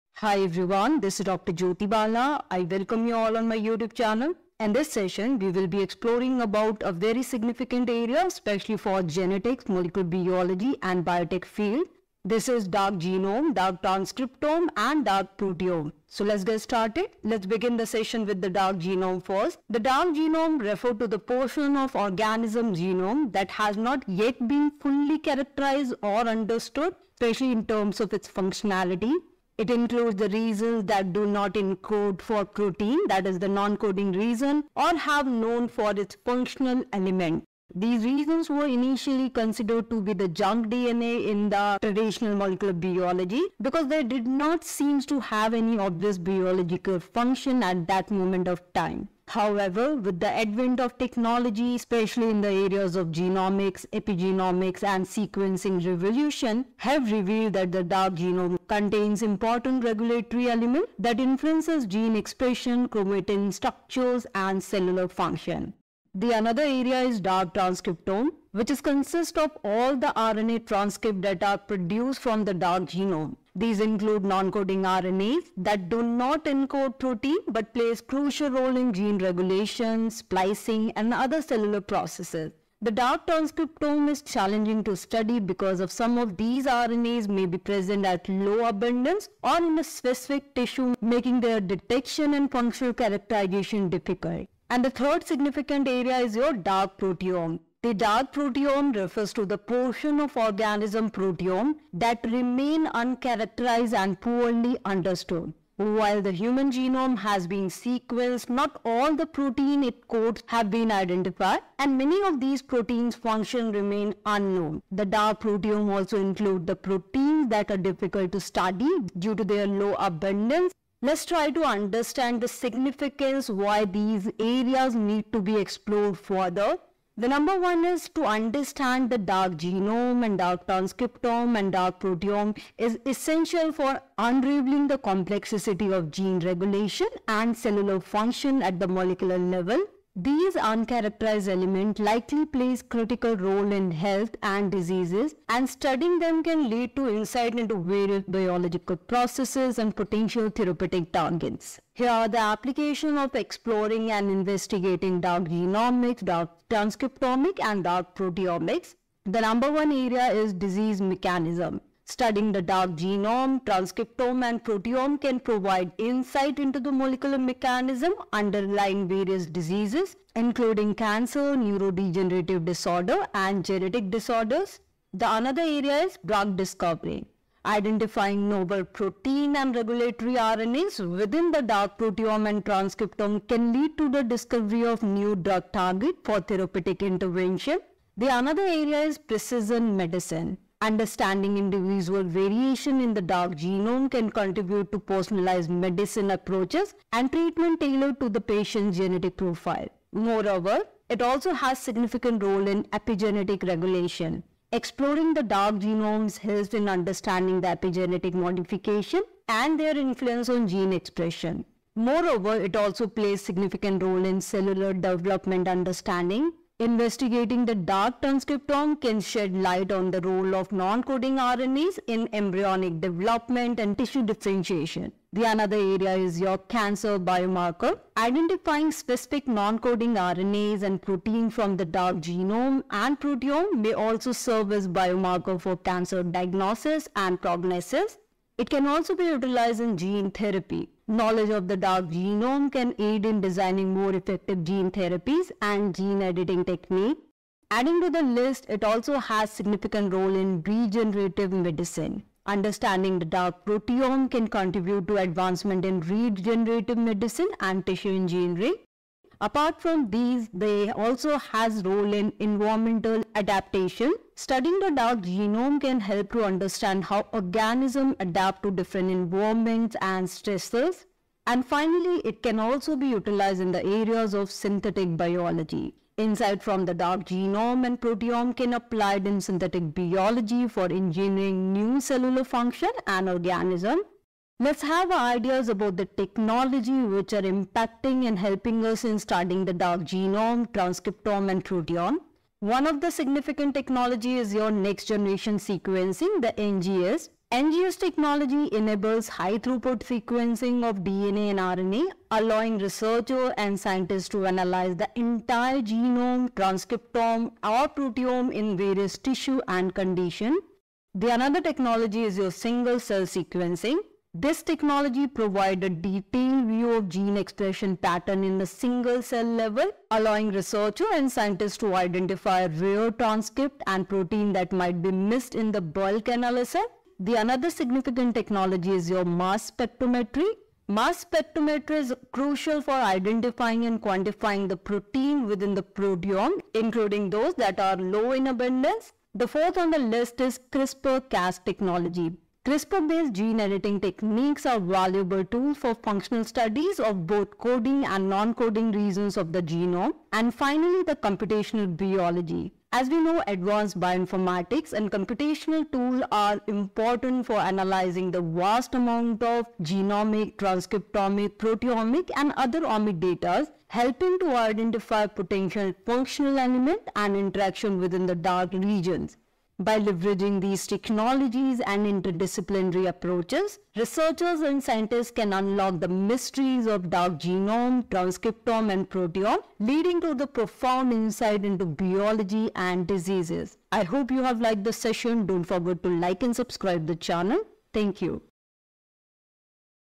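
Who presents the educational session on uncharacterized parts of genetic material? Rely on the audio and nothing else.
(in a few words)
Dr. Jyoti Bala.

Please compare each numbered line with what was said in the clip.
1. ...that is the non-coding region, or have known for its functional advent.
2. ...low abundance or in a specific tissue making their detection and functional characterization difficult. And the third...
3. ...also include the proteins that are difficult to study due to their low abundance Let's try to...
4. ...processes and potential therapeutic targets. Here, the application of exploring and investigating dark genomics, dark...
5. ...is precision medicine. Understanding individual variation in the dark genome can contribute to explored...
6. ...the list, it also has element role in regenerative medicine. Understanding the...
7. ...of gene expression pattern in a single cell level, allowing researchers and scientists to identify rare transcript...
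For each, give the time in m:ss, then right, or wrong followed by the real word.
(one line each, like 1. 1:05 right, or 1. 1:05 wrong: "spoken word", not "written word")
1. 0:33 wrong: "element", not "advent"
2. 1:28 right
3. 1:55 right
4. 2:28 right
5. 3:09 wrong: "personalized", not "explored"
6. 4:08 wrong: "significant", not "element"
7. 5:16 right.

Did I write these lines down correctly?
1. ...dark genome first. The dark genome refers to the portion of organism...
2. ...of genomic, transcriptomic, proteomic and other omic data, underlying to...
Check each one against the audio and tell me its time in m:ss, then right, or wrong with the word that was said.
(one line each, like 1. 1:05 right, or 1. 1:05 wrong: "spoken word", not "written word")
1. 0:18 right
2. 5:59 wrong: "helping", not "underlying".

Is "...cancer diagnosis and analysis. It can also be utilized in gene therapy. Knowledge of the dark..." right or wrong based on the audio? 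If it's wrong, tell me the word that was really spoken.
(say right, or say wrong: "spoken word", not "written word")
wrong: "prognosis", not "analysis".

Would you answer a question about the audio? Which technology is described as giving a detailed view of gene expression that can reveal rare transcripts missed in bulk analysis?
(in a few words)
single cell sequencing.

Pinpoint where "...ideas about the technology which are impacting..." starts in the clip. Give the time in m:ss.
4:45.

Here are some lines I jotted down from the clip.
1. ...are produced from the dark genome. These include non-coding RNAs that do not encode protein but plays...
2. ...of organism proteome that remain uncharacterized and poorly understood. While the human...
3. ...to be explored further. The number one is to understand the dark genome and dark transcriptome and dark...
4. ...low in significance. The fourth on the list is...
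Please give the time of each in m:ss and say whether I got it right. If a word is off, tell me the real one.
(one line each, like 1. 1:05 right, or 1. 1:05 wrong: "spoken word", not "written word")
1. 1:11 right
2. 1:40 right
3. 2:05 right
4. 5:37 wrong: "abundance", not "significance".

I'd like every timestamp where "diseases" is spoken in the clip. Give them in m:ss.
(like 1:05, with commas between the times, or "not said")
2:24, 2:40, 2:49, 6:23.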